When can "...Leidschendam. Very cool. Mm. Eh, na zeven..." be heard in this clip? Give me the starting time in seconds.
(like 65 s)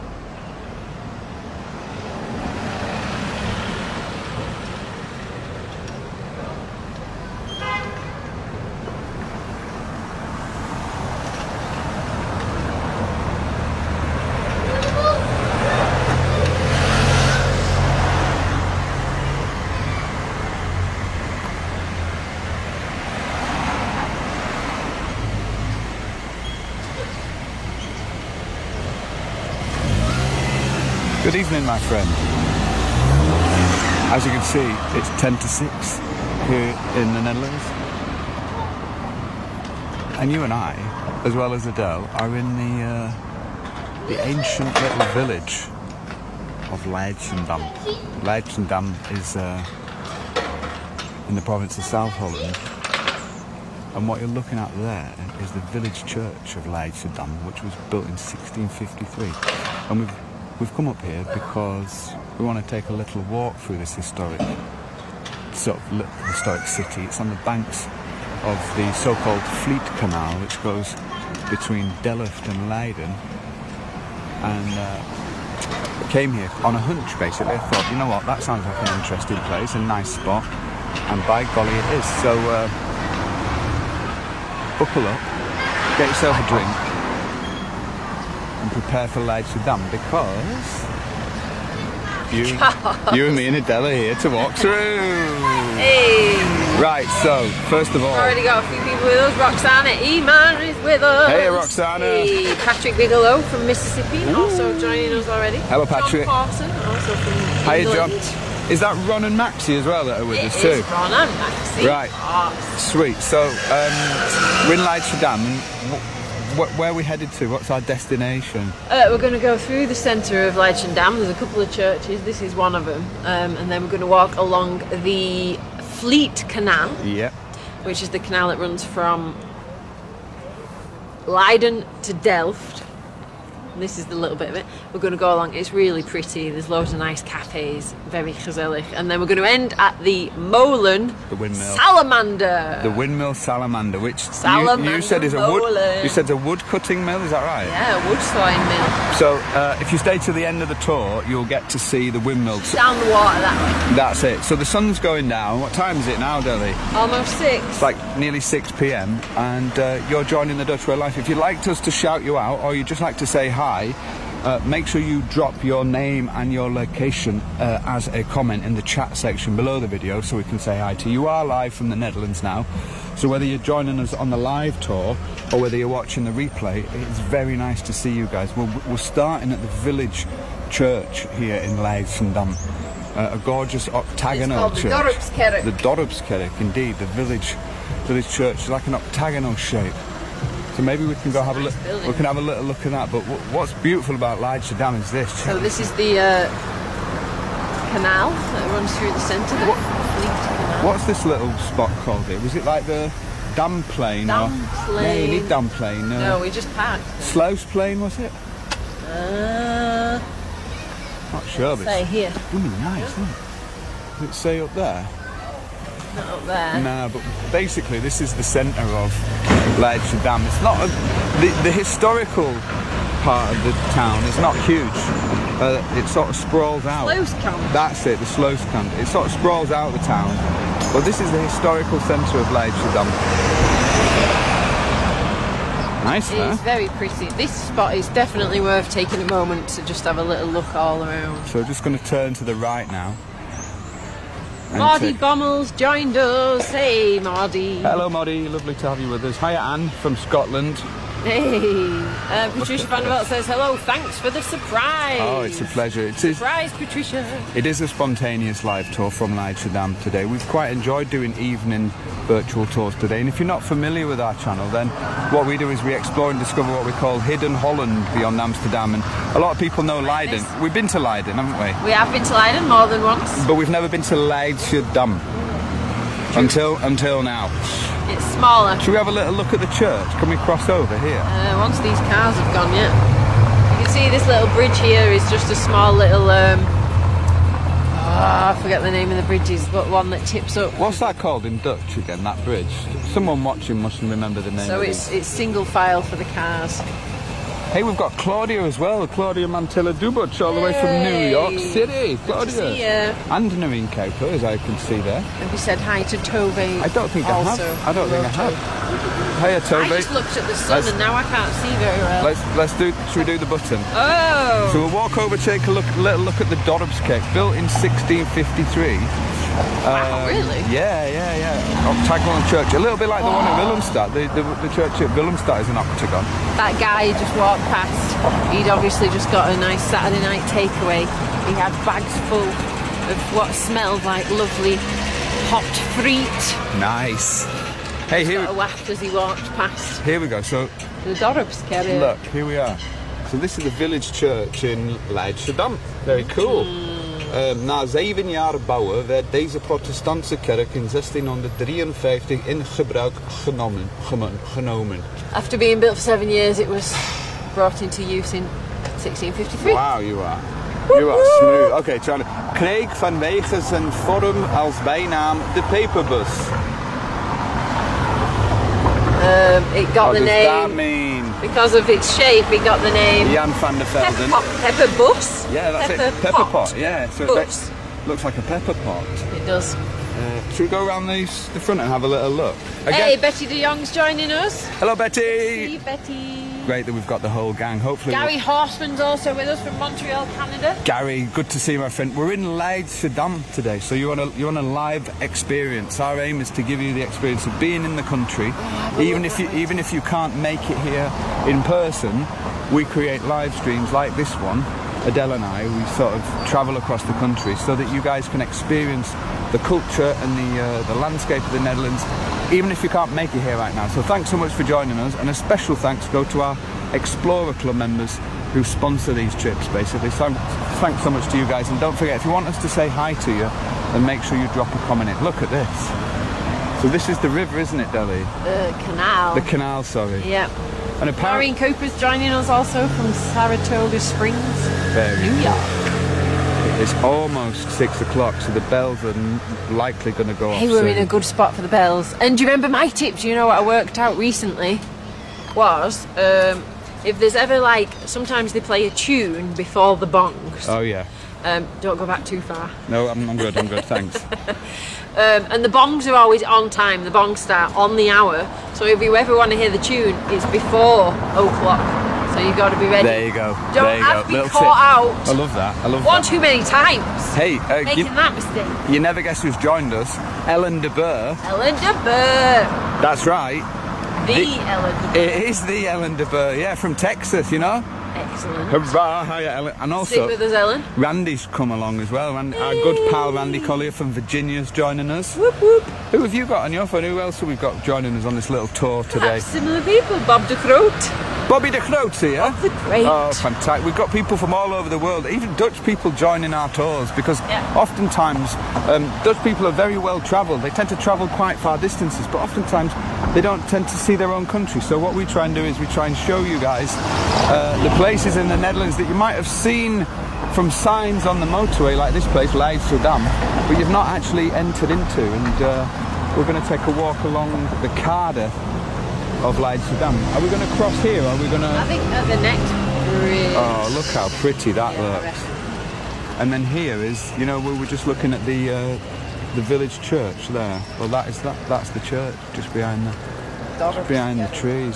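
345 s.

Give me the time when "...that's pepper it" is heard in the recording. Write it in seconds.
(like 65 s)
375 s.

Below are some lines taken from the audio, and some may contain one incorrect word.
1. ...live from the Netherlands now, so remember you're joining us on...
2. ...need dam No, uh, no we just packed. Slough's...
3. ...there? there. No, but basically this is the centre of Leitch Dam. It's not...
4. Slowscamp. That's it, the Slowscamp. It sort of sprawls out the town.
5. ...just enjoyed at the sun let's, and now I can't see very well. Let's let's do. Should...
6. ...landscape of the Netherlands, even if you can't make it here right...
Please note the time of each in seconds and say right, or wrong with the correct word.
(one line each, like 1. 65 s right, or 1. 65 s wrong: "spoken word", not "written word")
1. 171 s wrong: "whether", not "remember"
2. 205 s right
3. 214 s right
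4. 227 s right
5. 309 s wrong: "looked", not "enjoyed"
6. 410 s right.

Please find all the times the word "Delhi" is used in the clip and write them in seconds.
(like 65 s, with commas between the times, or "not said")
156 s, 427 s.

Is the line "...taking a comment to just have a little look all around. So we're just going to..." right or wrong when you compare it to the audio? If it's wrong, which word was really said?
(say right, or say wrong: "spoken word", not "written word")
wrong: "moment", not "comment".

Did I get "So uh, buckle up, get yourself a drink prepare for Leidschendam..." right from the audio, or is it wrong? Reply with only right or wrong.
right.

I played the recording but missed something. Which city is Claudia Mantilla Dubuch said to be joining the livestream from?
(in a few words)
New York City.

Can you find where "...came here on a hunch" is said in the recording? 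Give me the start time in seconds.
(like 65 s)
76 s.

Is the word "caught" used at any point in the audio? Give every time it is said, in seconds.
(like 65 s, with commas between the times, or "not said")
464 s.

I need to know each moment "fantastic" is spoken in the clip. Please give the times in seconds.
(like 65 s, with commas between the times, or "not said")
493 s.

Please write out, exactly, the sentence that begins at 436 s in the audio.
It's almost six o'clock, so the bells are likely going to go off.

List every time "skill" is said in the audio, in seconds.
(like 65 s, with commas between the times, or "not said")
not said.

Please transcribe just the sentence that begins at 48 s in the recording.
Leidschendam is uh, in the province of South Holland.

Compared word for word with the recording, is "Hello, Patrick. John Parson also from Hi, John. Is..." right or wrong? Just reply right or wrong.
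right.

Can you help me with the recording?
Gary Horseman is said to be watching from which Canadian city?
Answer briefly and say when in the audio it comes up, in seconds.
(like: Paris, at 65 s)
Montreal, at 389 s.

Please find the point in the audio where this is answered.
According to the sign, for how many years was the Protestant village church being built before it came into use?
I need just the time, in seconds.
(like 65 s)
356 s.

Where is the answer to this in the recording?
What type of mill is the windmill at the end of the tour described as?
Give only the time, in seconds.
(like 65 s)
148 s.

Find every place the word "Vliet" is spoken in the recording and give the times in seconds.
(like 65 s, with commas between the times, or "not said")
69 s, 125 s.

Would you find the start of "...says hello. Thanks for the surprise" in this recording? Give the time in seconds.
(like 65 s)
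253 s.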